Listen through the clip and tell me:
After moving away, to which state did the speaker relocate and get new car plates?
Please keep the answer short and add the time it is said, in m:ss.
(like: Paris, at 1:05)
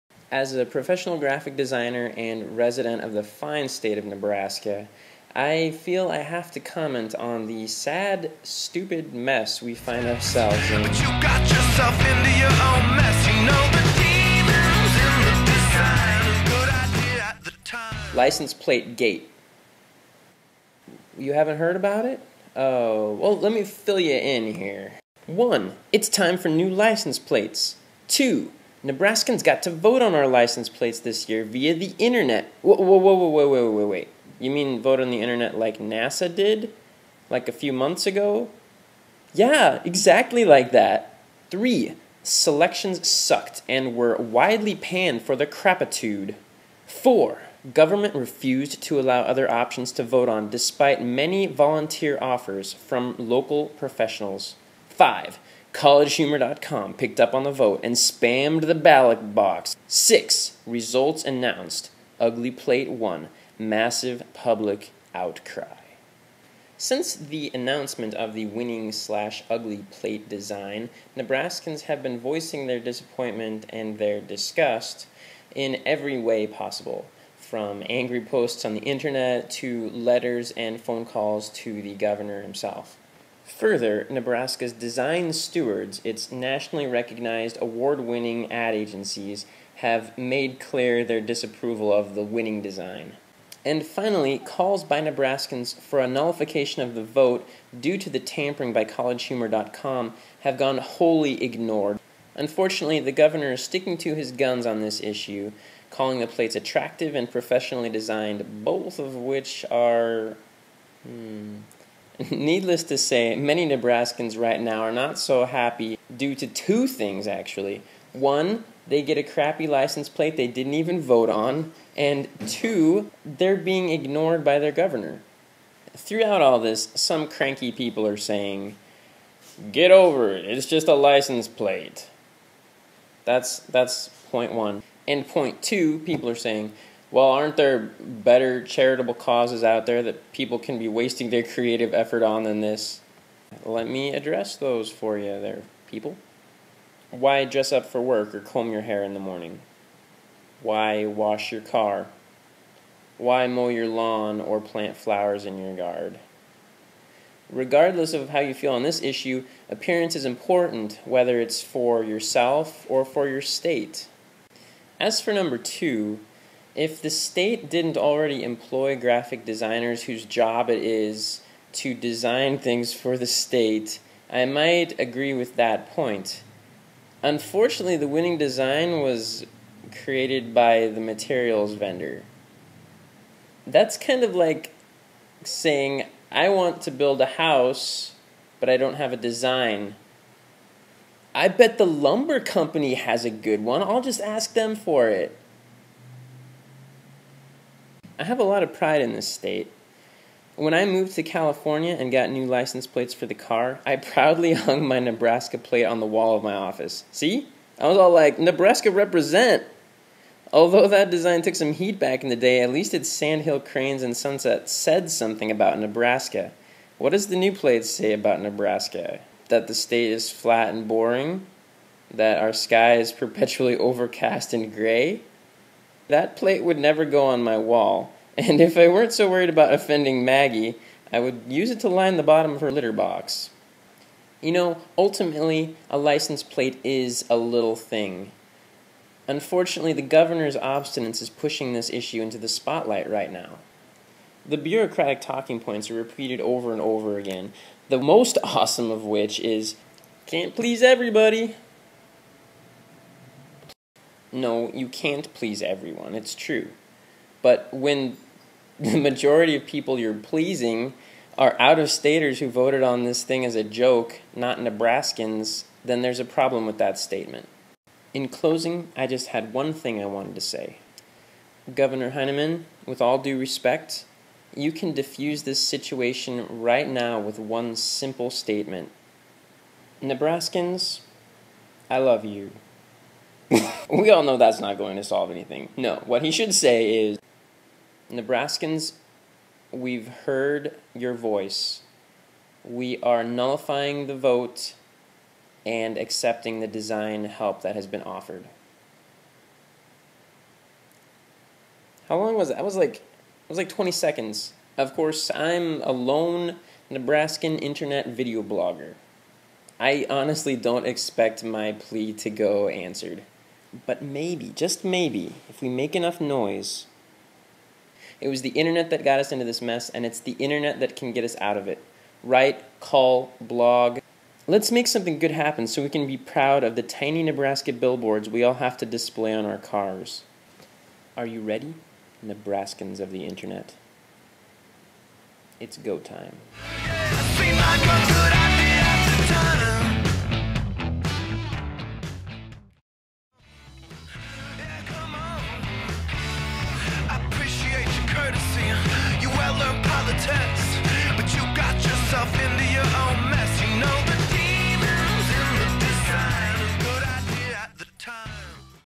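California, at 3:21.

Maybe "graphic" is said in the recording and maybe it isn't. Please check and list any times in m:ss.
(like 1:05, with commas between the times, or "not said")
0:01, 2:48.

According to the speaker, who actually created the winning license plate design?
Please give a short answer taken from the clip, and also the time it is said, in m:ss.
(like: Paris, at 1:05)
the materials vendor, at 3:00.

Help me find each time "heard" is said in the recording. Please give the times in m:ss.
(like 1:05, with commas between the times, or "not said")
0:21, 4:50.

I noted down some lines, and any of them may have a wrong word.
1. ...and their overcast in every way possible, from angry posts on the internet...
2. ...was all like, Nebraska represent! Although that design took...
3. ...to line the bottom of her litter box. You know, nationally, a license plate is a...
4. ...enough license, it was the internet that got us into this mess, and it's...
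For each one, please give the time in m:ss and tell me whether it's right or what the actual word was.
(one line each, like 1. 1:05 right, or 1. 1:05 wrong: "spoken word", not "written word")
1. 1:13 wrong: "disgust", not "overcast"
2. 3:27 right
3. 3:51 wrong: "ultimately", not "nationally"
4. 5:15 wrong: "noise", not "license".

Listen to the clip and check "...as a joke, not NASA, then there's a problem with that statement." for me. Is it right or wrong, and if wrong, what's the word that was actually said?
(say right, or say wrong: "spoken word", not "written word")
wrong: "Nebraskans", not "NASA".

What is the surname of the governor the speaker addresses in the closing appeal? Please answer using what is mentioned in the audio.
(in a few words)
Heineman.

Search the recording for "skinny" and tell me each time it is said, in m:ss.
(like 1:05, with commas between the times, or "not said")
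not said.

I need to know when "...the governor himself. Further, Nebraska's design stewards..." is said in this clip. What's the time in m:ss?
1:21.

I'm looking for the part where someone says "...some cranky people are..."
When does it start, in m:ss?
2:06.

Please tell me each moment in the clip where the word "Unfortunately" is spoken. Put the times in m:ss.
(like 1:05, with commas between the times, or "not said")
1:42, 2:57, 3:59.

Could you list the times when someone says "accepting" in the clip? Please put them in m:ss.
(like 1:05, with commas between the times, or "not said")
4:55.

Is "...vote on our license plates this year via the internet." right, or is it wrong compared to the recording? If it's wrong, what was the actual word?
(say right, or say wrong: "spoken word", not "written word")
right.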